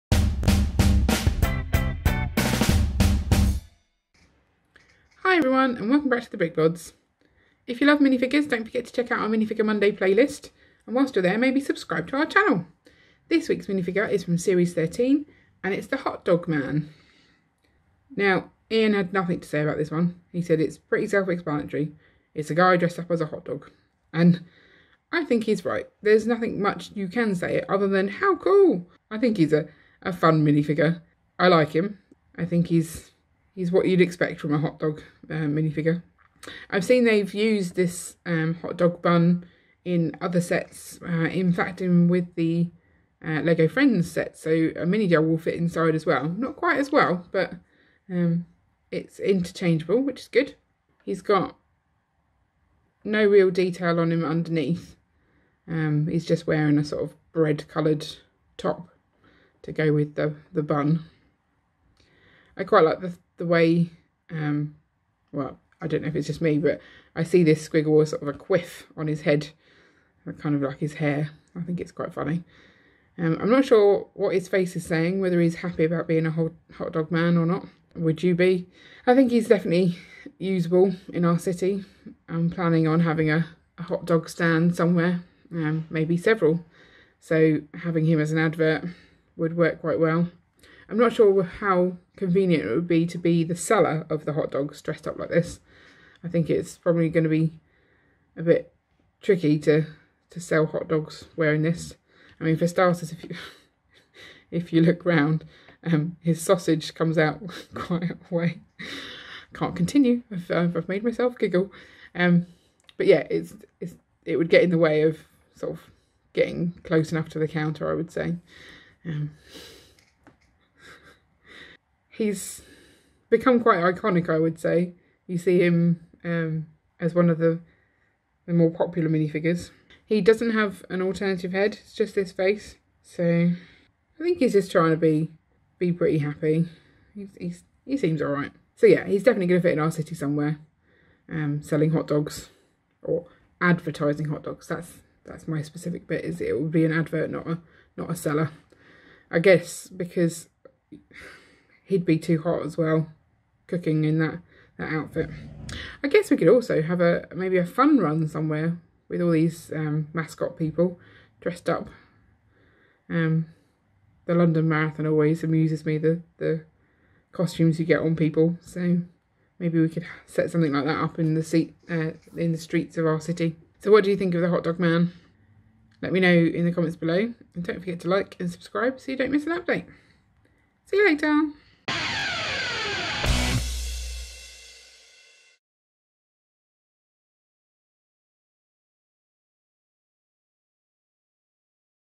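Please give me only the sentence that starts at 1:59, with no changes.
Um, he's become quite iconic, I would say.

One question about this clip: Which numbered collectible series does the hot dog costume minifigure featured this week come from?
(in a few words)
Series 13.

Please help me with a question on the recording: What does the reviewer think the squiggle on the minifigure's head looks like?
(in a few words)
a quiff.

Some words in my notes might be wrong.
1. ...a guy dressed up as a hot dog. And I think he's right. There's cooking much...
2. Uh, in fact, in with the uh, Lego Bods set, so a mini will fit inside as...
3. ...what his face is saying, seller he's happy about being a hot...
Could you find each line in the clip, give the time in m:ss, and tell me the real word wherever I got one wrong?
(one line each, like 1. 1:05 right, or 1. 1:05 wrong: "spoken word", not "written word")
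1. 0:22 wrong: "nothing", not "cooking"
2. 0:41 wrong: "Friends", not "Bods"
3. 1:14 wrong: "whether", not "seller".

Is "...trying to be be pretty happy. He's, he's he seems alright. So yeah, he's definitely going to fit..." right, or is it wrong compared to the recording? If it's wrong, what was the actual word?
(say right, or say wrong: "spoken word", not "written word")
right.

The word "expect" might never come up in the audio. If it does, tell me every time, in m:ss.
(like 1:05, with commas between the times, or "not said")
0:34.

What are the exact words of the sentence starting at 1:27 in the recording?
So having him as an advert would work quite well.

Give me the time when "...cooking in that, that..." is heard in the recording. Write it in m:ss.
2:33.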